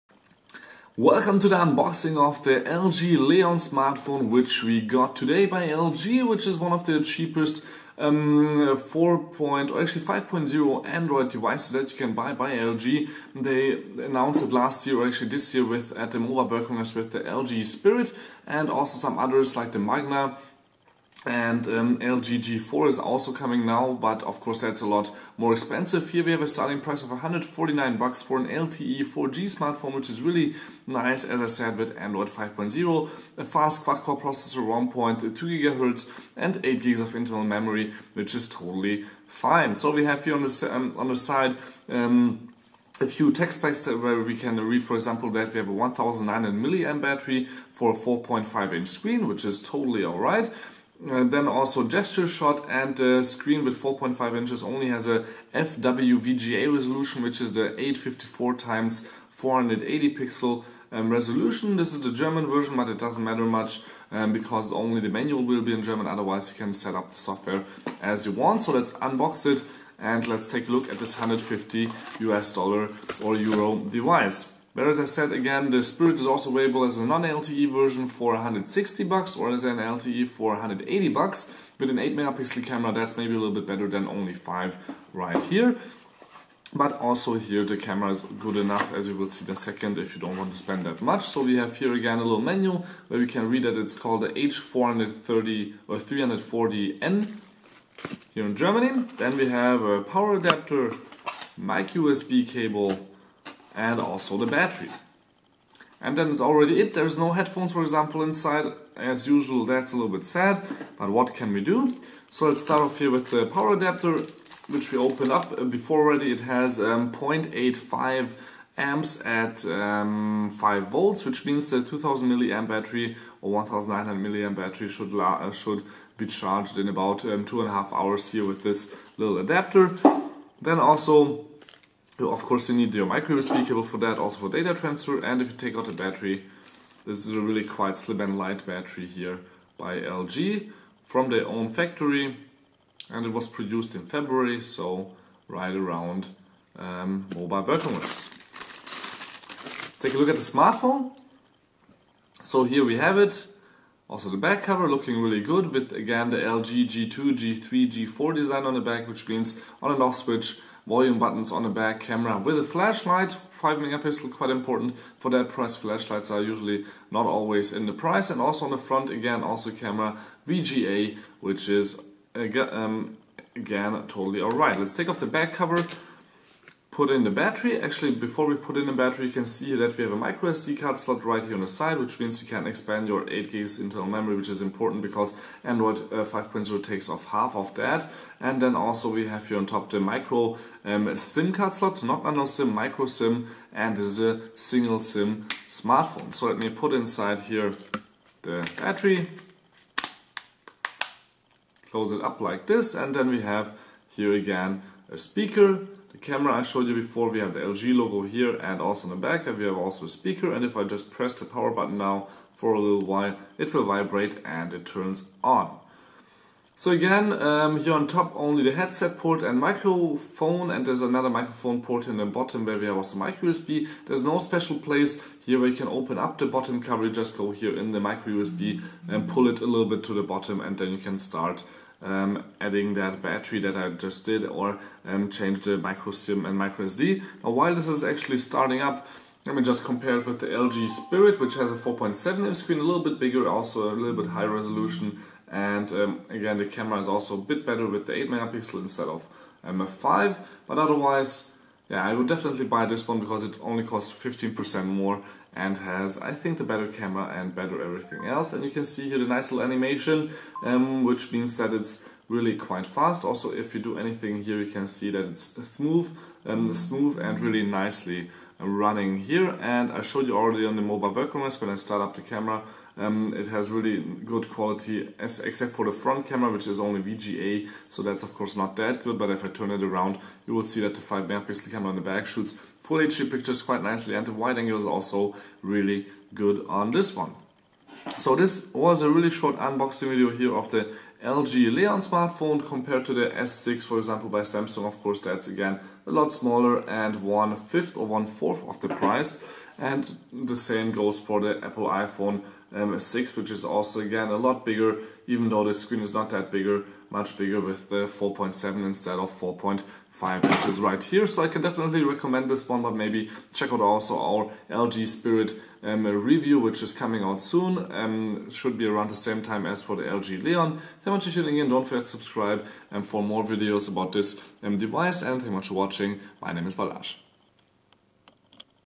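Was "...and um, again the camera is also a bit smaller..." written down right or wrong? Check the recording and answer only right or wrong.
wrong.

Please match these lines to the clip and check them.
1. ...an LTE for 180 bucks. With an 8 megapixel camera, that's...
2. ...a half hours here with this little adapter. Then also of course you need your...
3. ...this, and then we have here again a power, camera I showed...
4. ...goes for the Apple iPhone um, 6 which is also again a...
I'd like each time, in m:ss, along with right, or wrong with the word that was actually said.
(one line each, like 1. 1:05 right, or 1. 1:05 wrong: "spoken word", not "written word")
1. 1:19 right
2. 2:07 right
3. 3:22 wrong: "speaker", not "power"
4. 5:00 right.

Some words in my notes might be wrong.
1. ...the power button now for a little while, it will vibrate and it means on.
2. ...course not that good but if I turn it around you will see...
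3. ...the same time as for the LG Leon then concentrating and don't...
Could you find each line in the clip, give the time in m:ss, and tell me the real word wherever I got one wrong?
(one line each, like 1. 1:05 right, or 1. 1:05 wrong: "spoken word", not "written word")
1. 3:31 wrong: "turns", not "means"
2. 4:38 right
3. 5:19 right.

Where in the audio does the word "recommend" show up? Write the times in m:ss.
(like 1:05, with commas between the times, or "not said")
5:12.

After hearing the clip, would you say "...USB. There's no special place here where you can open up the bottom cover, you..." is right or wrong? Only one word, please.
right.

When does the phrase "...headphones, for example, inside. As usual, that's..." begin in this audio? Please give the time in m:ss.
1:47.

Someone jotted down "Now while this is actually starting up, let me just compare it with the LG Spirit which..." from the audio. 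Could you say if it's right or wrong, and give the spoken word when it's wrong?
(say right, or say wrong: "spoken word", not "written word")
right.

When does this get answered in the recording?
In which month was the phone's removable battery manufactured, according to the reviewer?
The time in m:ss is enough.
2:24.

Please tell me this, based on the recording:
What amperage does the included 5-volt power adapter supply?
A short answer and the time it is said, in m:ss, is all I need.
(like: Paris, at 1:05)
0.85 amps, at 1:57.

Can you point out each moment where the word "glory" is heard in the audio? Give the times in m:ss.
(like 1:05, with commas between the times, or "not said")
not said.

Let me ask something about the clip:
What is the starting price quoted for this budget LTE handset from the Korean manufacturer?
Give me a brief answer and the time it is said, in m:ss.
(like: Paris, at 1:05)
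149 dollars, at 0:27.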